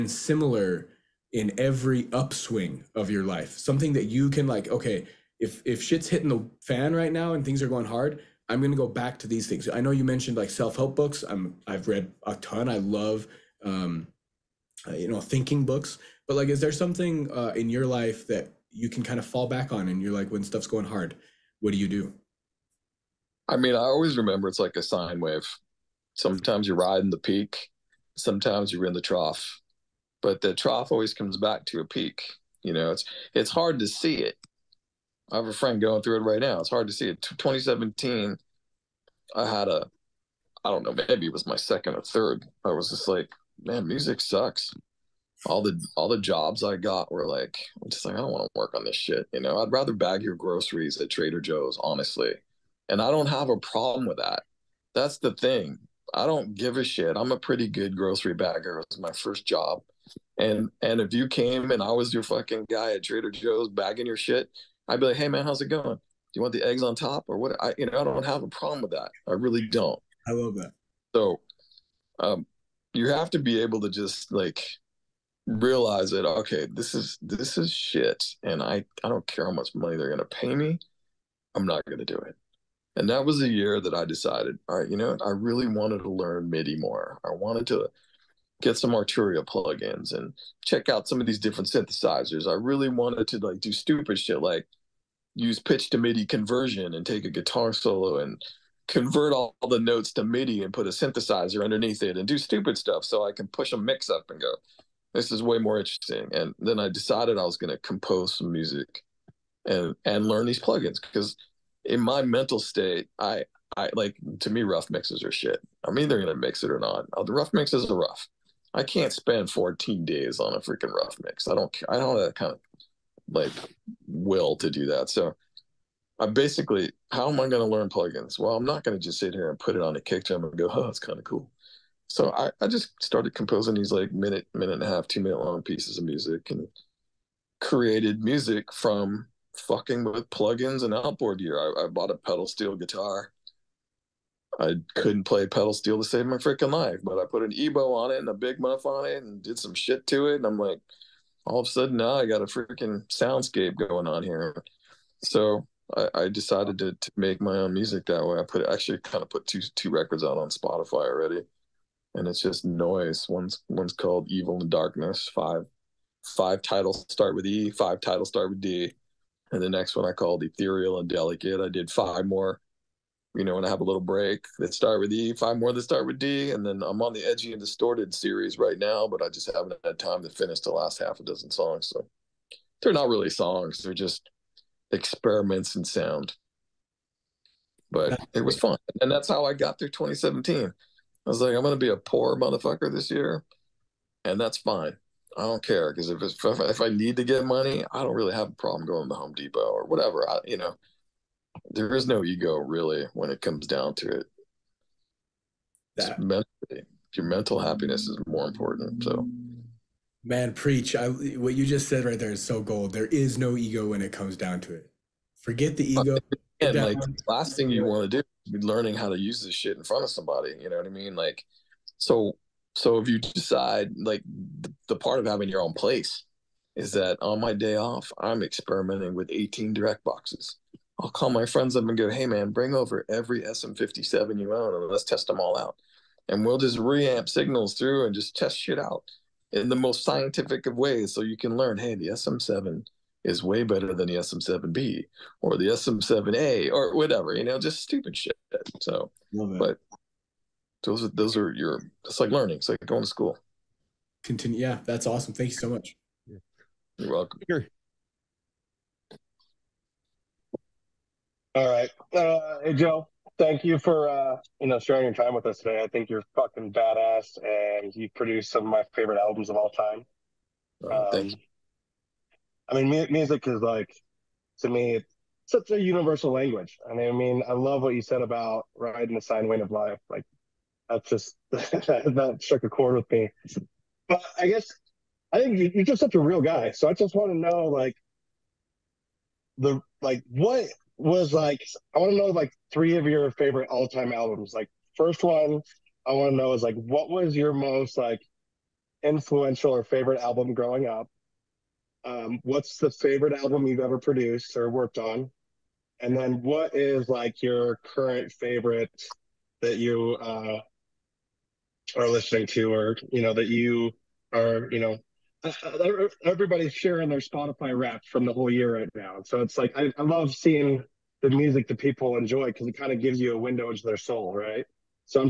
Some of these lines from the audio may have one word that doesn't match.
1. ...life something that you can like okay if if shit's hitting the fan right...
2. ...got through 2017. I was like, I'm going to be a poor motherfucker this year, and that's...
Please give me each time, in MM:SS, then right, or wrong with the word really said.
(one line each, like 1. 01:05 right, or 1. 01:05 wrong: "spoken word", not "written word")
1. 00:03 right
2. 03:09 right.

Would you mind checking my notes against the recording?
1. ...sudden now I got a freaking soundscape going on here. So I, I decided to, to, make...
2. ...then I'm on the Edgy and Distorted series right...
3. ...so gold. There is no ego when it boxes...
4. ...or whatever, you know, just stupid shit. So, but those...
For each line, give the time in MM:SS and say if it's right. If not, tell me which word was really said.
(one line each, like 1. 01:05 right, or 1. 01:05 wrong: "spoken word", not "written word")
1. 02:31 right
2. 02:56 right
3. 03:32 wrong: "comes", not "boxes"
4. 04:06 right.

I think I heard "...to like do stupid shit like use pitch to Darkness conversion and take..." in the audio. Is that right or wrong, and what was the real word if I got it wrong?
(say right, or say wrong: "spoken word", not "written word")
wrong: "MIDI", not "Darkness".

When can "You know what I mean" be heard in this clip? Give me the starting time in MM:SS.
03:40.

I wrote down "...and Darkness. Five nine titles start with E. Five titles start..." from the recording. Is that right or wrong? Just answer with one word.
wrong.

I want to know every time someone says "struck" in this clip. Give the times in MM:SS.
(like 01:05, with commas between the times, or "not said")
04:42.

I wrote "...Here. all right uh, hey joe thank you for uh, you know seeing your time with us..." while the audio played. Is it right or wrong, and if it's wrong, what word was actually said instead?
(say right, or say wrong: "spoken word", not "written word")
wrong: "sharing", not "seeing".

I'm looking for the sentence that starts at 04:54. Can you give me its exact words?
Like first one I want to know is like what was your most like influential or favorite album growing up?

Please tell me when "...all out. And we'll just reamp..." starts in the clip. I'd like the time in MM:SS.
03:55.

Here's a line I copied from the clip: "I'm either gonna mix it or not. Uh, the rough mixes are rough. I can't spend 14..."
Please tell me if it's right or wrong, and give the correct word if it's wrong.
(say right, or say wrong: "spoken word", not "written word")
right.